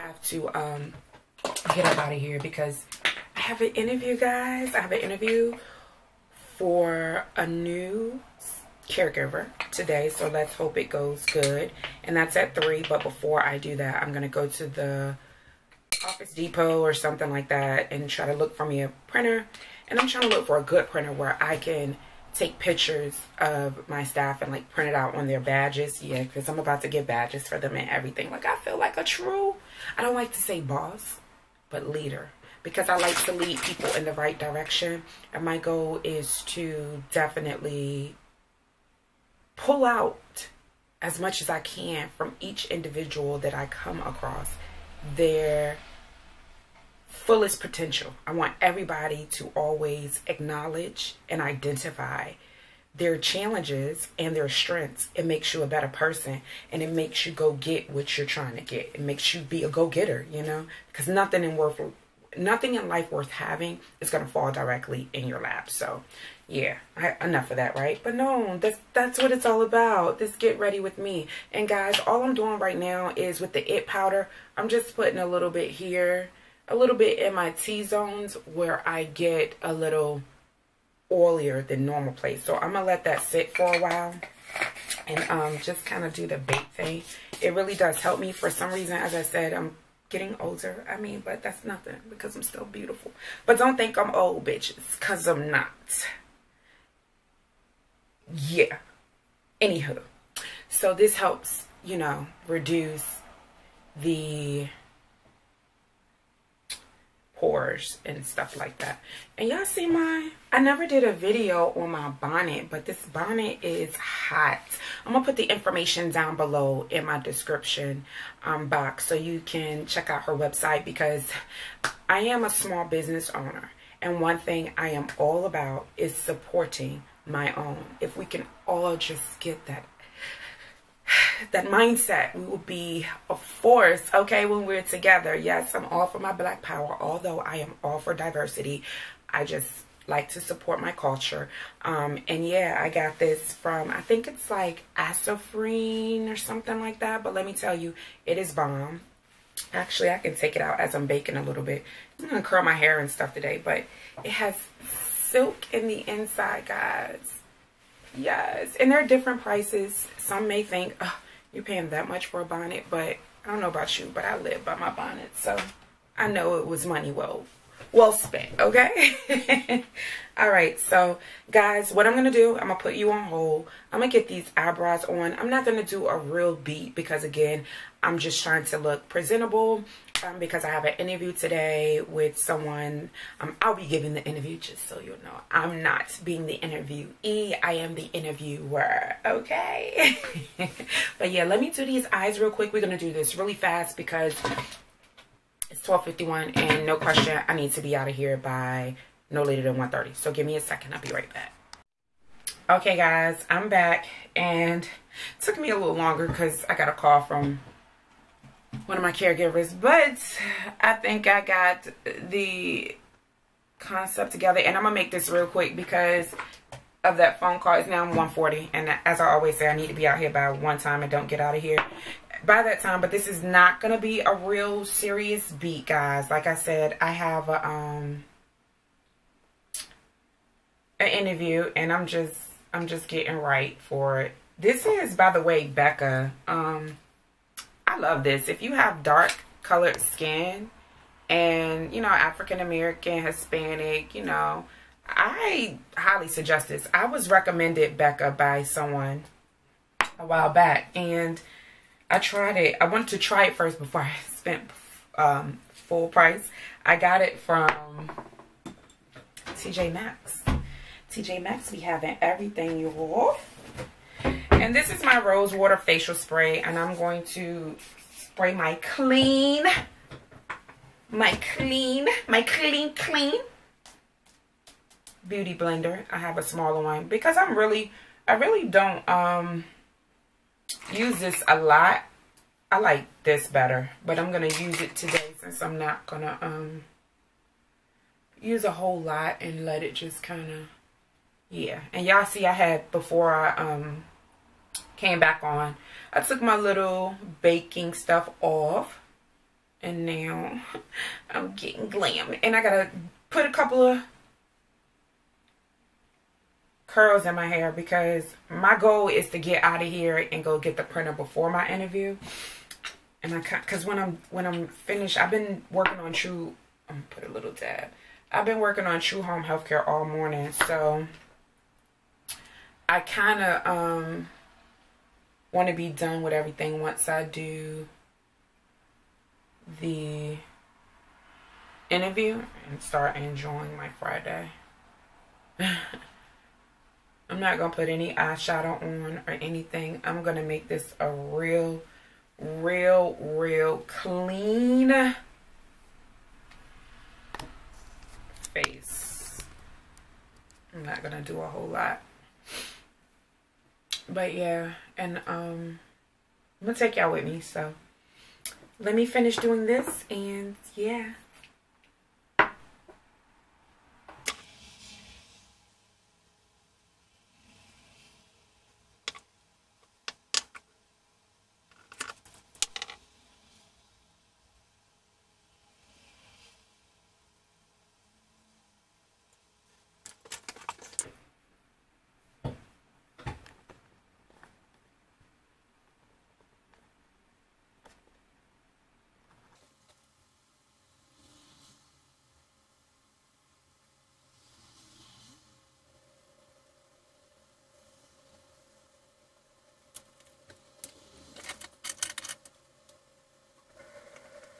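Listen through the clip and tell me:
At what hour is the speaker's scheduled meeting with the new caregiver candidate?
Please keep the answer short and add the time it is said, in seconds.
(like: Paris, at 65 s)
3, at 12 s.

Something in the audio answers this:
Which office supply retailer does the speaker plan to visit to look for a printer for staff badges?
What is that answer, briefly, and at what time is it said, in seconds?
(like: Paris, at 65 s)
Office Depot, at 16 s.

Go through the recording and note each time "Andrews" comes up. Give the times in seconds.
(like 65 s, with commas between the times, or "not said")
not said.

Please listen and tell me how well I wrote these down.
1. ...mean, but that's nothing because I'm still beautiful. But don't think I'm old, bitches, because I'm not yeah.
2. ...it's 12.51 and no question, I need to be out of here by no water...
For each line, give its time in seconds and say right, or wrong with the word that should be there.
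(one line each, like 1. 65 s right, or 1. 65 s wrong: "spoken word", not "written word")
1. 90 s right
2. 195 s wrong: "later", not "water".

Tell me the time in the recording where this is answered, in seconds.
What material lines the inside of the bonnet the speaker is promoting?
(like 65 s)
155 s.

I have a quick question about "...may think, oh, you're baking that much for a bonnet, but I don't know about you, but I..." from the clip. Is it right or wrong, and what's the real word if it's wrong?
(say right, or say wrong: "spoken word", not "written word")
wrong: "paying", not "baking".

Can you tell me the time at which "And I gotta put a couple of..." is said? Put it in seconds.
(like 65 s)
302 s.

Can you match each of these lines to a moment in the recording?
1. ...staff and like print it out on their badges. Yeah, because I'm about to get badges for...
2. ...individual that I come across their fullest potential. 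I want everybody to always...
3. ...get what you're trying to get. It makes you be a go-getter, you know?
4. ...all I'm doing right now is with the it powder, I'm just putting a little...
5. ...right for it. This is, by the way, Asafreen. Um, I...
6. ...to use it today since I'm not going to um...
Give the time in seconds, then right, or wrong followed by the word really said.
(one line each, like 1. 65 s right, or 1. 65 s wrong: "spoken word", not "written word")
1. 24 s right
2. 42 s right
3. 57 s right
4. 72 s right
5. 233 s wrong: "Becca", not "Asafreen"
6. 284 s right.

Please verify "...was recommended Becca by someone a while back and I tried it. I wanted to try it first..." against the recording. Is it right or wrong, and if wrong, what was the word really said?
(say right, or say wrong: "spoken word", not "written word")
right.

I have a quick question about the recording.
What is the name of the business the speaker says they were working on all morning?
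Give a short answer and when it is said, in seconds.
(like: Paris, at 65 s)
True Home Healthcare, at 318 s.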